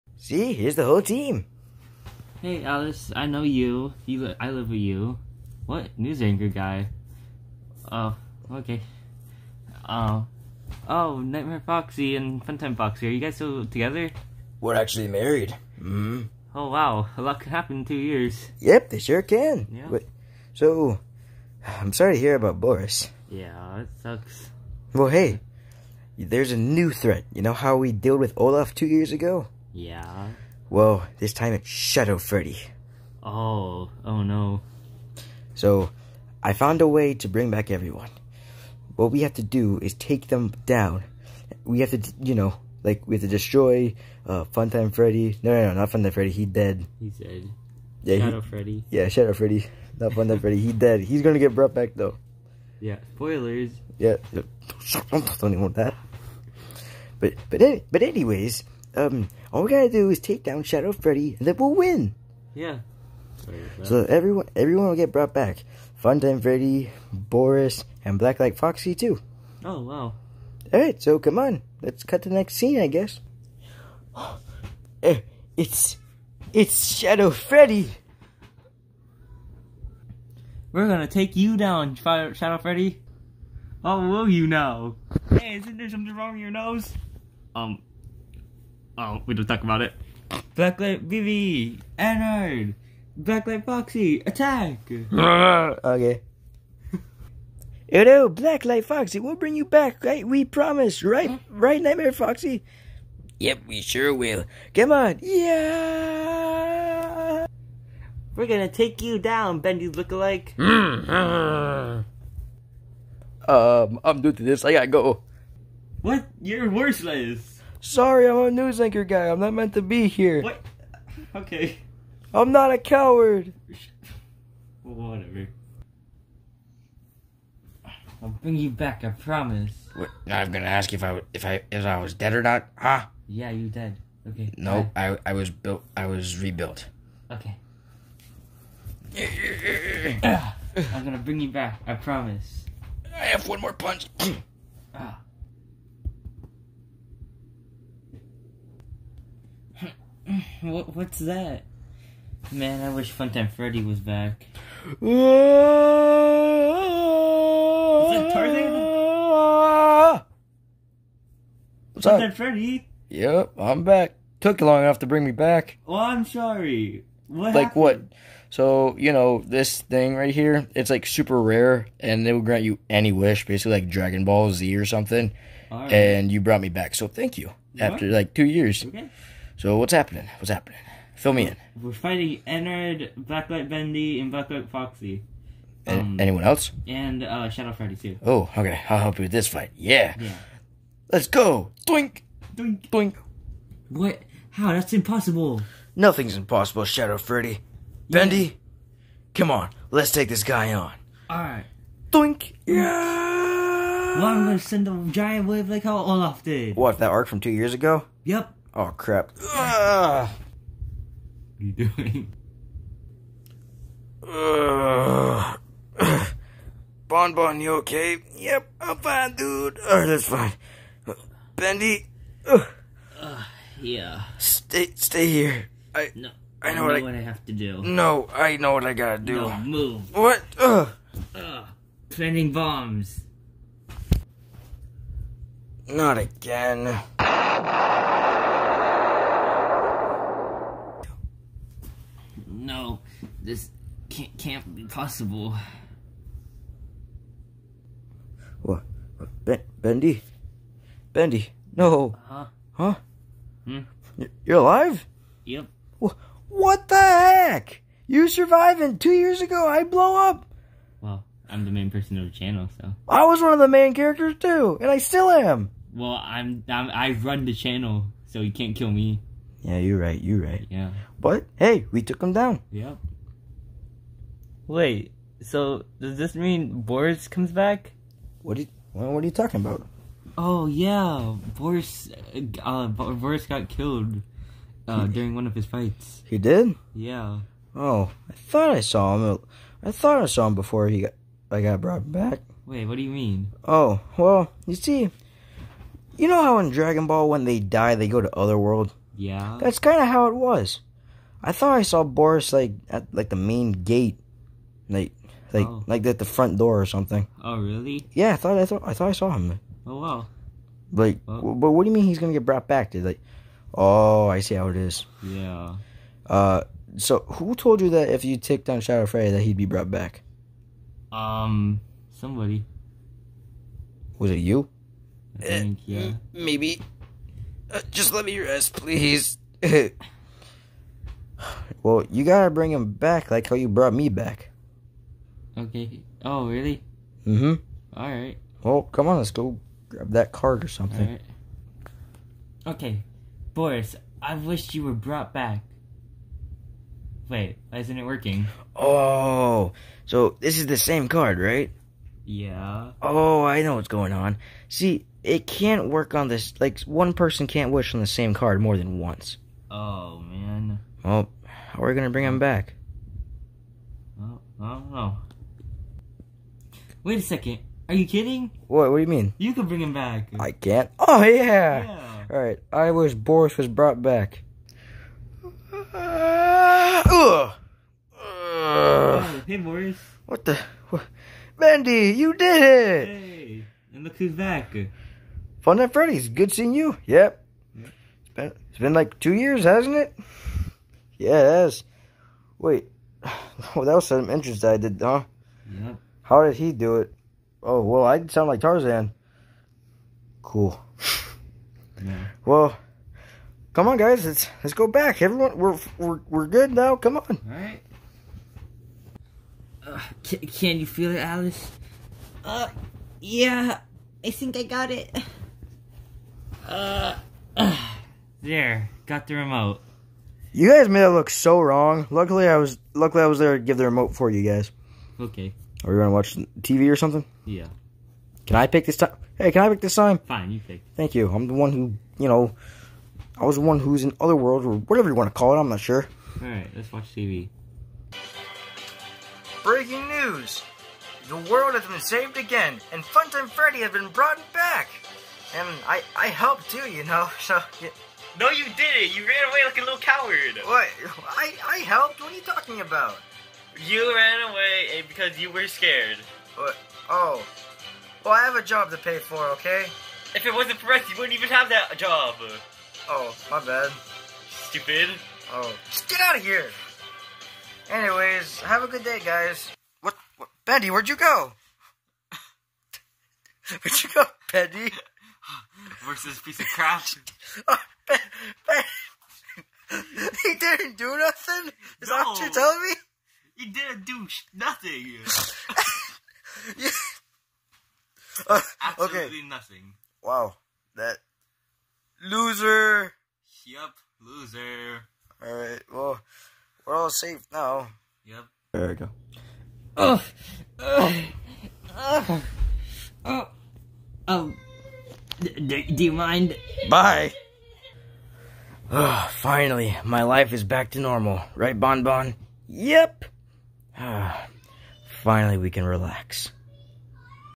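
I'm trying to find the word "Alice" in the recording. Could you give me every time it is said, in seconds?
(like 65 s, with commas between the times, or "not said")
2 s, 411 s.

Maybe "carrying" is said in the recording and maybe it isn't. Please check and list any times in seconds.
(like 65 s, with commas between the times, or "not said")
not said.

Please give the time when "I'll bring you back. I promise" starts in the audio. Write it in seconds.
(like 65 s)
128 s.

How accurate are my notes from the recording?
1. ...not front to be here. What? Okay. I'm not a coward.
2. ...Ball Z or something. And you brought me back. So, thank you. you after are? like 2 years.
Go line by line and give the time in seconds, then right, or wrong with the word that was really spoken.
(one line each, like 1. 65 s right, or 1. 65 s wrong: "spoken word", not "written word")
1. 119 s wrong: "meant", not "front"
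2. 174 s right.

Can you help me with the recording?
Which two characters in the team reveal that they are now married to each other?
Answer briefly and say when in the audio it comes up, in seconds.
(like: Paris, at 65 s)
Nightmare Foxy and Funtime Foxy, at 11 s.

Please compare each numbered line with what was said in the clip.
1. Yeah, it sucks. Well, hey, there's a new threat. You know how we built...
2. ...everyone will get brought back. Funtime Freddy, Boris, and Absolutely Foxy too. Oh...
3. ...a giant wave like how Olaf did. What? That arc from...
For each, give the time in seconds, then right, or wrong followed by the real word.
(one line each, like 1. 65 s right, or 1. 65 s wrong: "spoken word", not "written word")
1. 23 s wrong: "dealt", not "built"
2. 64 s wrong: "Blacklight", not "Absolutely"
3. 204 s right.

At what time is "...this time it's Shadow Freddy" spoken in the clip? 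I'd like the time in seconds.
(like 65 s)
31 s.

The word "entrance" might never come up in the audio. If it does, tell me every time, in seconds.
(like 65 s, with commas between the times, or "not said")
394 s.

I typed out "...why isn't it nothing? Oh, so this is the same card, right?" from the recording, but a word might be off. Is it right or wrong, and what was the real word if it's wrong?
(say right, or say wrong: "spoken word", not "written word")
wrong: "working", not "nothing".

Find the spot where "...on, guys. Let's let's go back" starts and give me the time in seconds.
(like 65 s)
403 s.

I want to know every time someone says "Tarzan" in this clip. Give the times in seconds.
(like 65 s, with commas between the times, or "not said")
158 s, 398 s.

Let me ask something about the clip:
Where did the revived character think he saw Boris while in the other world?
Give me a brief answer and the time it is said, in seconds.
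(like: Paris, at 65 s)
the main gate, at 303 s.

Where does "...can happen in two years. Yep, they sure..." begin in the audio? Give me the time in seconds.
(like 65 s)
17 s.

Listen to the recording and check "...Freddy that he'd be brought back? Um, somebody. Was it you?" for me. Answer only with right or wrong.
right.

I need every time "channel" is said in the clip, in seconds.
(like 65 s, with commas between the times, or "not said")
262 s, 267 s.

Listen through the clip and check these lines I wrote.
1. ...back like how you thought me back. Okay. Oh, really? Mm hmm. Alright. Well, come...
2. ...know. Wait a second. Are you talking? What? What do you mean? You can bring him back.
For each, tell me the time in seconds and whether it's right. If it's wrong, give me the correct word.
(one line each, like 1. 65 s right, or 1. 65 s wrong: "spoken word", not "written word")
1. 332 s wrong: "brought", not "thought"
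2. 364 s wrong: "kidding", not "talking".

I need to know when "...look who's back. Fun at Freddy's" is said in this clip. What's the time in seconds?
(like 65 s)
384 s.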